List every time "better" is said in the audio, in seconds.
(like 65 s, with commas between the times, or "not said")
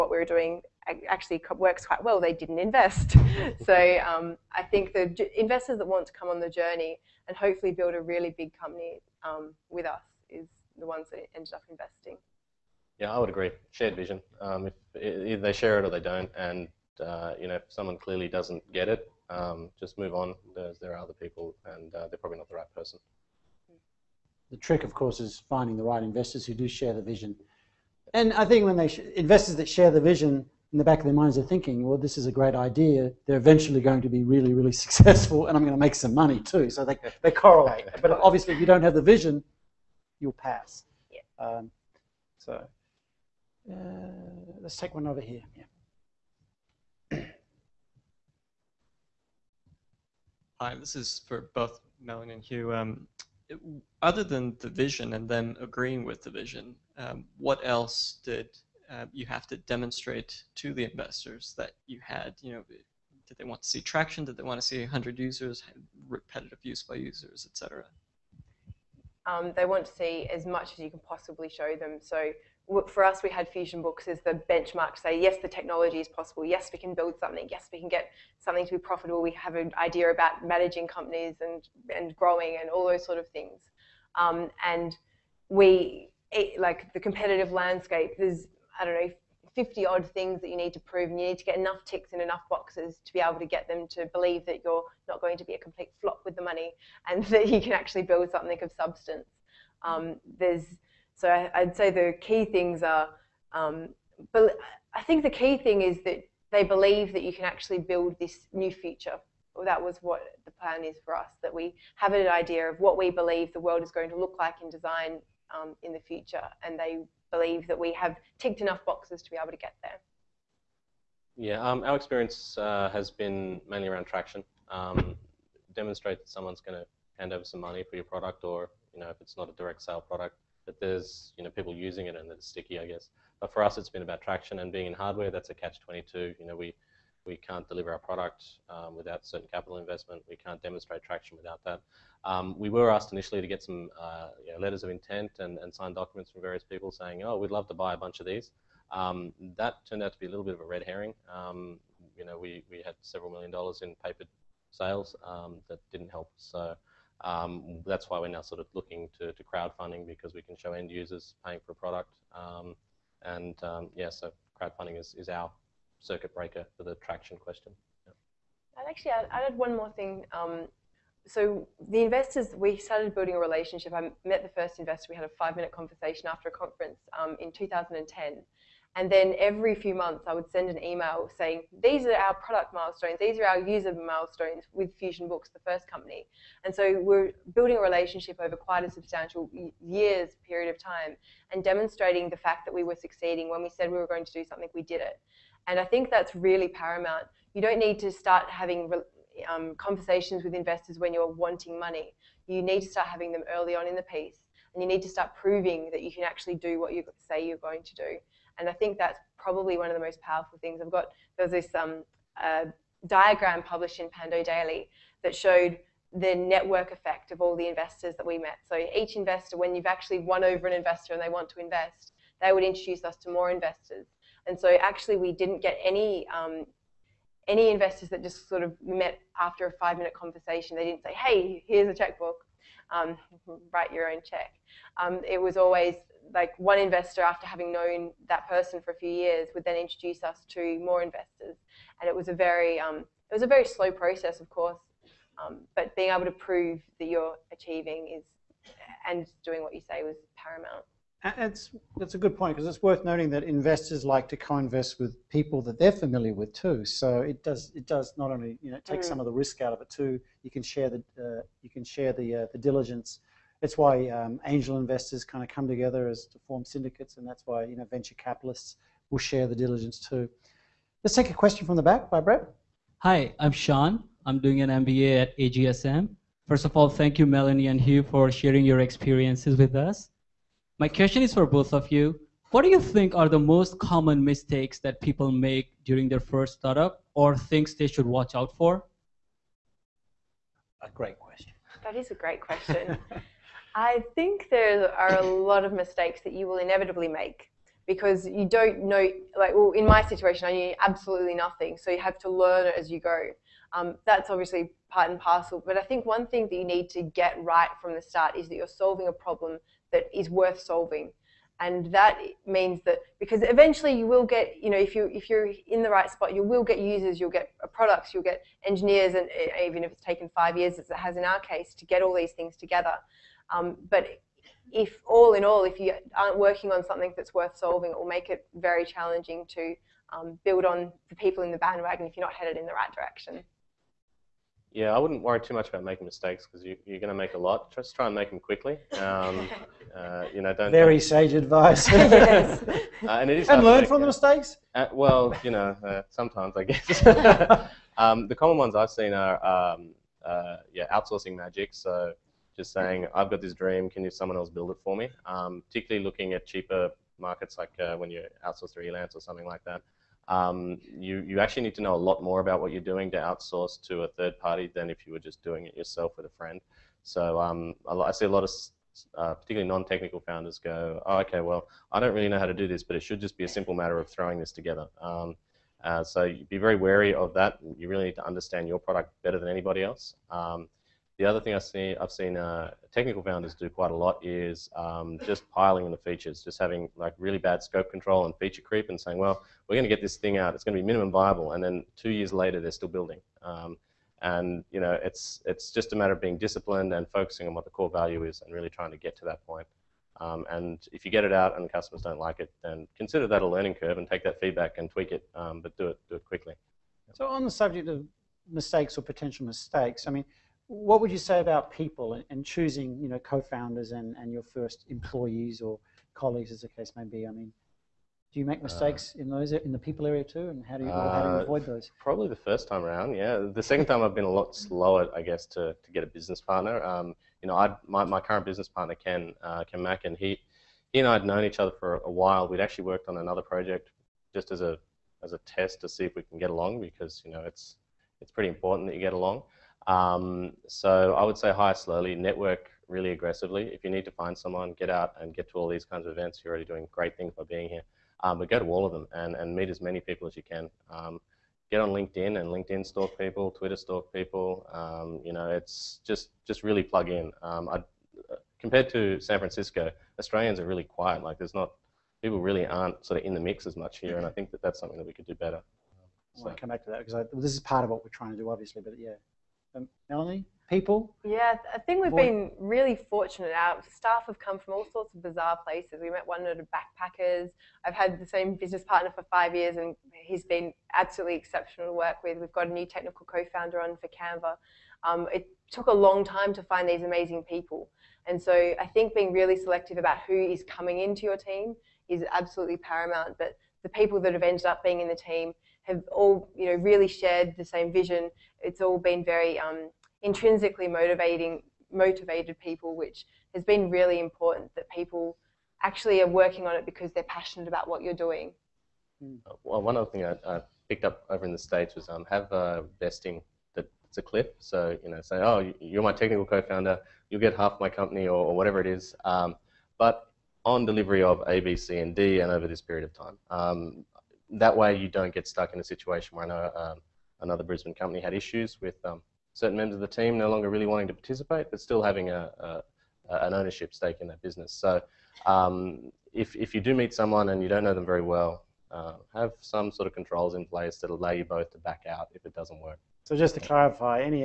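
379 s, 465 s.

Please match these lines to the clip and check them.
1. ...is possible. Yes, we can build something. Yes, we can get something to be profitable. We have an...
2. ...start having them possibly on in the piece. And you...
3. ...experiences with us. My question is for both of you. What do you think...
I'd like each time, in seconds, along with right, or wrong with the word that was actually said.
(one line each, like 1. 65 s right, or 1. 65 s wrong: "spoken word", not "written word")
1. 75 s right
2. 202 s wrong: "early", not "possibly"
3. 278 s right.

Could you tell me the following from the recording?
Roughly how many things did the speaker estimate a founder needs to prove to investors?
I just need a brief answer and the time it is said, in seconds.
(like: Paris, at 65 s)
50, at 89 s.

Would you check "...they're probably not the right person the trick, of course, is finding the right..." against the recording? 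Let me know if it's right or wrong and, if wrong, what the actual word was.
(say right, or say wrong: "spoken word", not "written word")
right.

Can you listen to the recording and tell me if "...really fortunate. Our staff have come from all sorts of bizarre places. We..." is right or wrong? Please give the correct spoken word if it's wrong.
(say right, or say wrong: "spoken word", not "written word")
right.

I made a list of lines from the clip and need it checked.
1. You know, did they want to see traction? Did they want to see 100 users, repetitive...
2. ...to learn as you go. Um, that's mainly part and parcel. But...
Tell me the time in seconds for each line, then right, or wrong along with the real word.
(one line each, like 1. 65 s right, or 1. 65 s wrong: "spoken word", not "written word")
1. 62 s right
2. 302 s wrong: "obviously", not "mainly".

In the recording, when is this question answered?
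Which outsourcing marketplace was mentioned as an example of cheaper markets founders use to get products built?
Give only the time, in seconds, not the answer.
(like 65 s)
358 s.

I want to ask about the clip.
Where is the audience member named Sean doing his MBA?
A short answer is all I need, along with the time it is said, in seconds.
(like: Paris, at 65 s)
AGSM, at 275 s.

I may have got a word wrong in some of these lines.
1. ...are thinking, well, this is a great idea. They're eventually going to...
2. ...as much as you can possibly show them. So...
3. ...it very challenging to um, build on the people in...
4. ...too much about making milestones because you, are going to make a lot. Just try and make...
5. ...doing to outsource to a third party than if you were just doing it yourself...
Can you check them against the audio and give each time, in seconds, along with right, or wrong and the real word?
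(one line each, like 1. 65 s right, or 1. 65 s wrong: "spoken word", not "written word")
1. 31 s right
2. 70 s right
3. 328 s right
4. 335 s wrong: "mistakes", not "milestones"
5. 362 s right.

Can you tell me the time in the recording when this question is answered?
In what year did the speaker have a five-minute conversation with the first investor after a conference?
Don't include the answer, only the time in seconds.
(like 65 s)
177 s.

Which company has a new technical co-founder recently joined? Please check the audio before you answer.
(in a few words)
Canva.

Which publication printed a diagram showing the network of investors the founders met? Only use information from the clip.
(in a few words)
Pando Daily.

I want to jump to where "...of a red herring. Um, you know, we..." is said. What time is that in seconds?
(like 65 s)
150 s.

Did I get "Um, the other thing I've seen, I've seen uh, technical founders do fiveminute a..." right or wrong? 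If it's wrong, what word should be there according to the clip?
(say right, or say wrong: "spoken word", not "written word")
wrong: "quite", not "fiveminute".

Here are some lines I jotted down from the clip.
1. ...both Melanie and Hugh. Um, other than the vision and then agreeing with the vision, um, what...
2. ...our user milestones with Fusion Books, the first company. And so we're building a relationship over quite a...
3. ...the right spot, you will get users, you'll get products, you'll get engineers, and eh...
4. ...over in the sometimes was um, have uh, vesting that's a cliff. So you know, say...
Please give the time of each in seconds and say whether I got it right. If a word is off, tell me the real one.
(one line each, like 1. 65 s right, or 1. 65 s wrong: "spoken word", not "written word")
1. 51 s right
2. 183 s right
3. 315 s right
4. 511 s wrong: "states", not "sometimes".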